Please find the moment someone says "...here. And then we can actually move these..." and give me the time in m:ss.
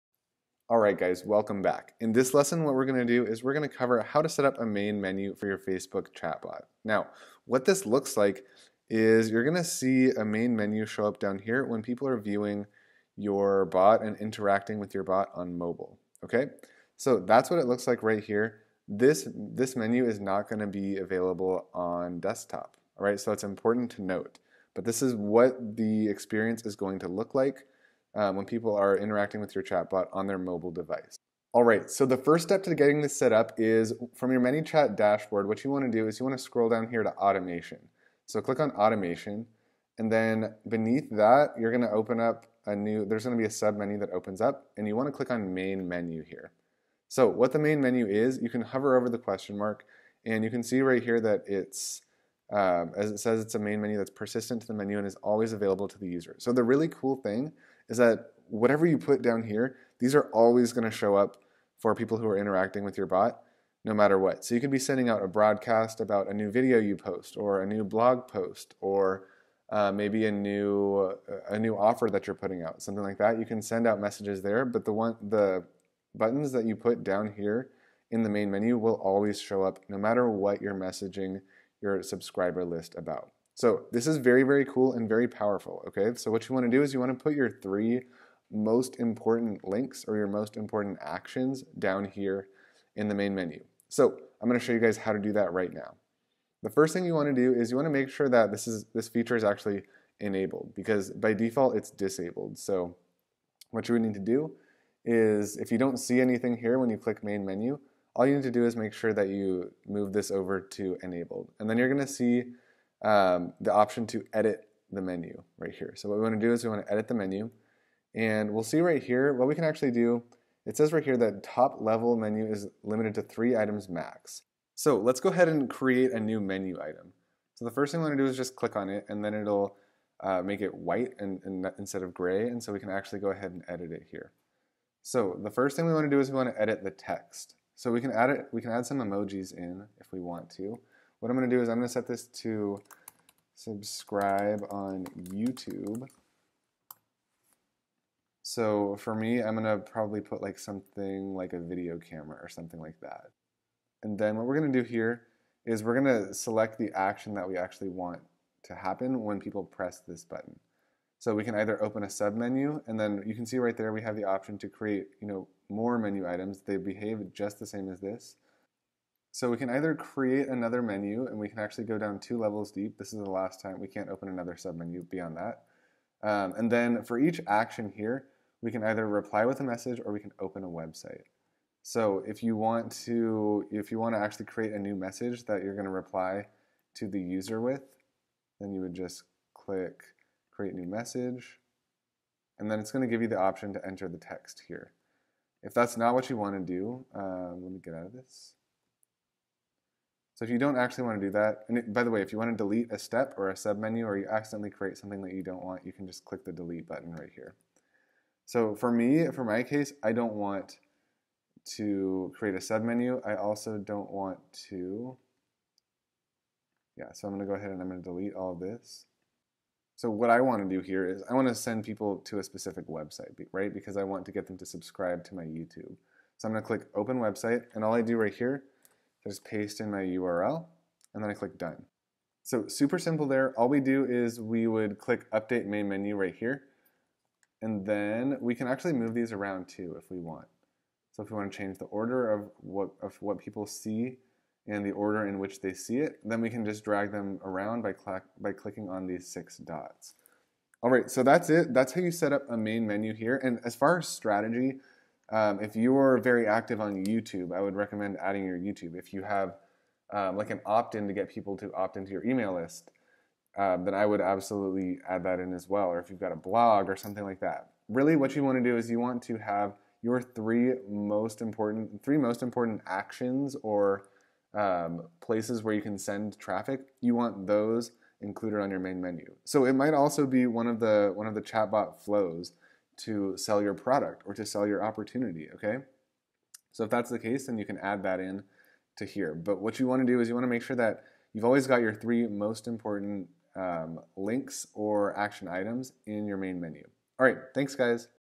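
3:56.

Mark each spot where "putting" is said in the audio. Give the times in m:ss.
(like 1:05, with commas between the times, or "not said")
1:12.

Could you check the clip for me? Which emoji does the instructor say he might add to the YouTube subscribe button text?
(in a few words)
Video camera.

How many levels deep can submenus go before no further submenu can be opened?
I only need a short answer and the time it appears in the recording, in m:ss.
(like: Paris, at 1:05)
2, at 2:52.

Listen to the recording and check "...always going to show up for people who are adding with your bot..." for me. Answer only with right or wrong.
wrong.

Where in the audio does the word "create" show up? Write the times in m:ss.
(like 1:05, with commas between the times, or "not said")
2:05, 2:44, 2:49, 3:04, 3:10, 3:24, 3:32.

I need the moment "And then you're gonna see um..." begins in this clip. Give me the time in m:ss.
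1:51.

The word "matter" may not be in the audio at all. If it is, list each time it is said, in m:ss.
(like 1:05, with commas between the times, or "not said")
1:03, 1:19.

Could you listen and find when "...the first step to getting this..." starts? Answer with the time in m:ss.
0:32.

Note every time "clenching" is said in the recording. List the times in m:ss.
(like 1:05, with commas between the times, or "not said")
not said.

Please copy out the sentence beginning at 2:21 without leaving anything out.
What I'm going to do is I'm going to set this to subscribe on YouTube.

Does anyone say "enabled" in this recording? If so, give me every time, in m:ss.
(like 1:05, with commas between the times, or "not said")
1:40, 1:51.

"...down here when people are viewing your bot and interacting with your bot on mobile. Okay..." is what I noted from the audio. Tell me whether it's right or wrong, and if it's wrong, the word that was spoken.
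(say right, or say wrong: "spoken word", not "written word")
right.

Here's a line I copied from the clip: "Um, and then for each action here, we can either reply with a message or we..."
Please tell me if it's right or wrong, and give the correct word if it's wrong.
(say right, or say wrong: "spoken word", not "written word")
right.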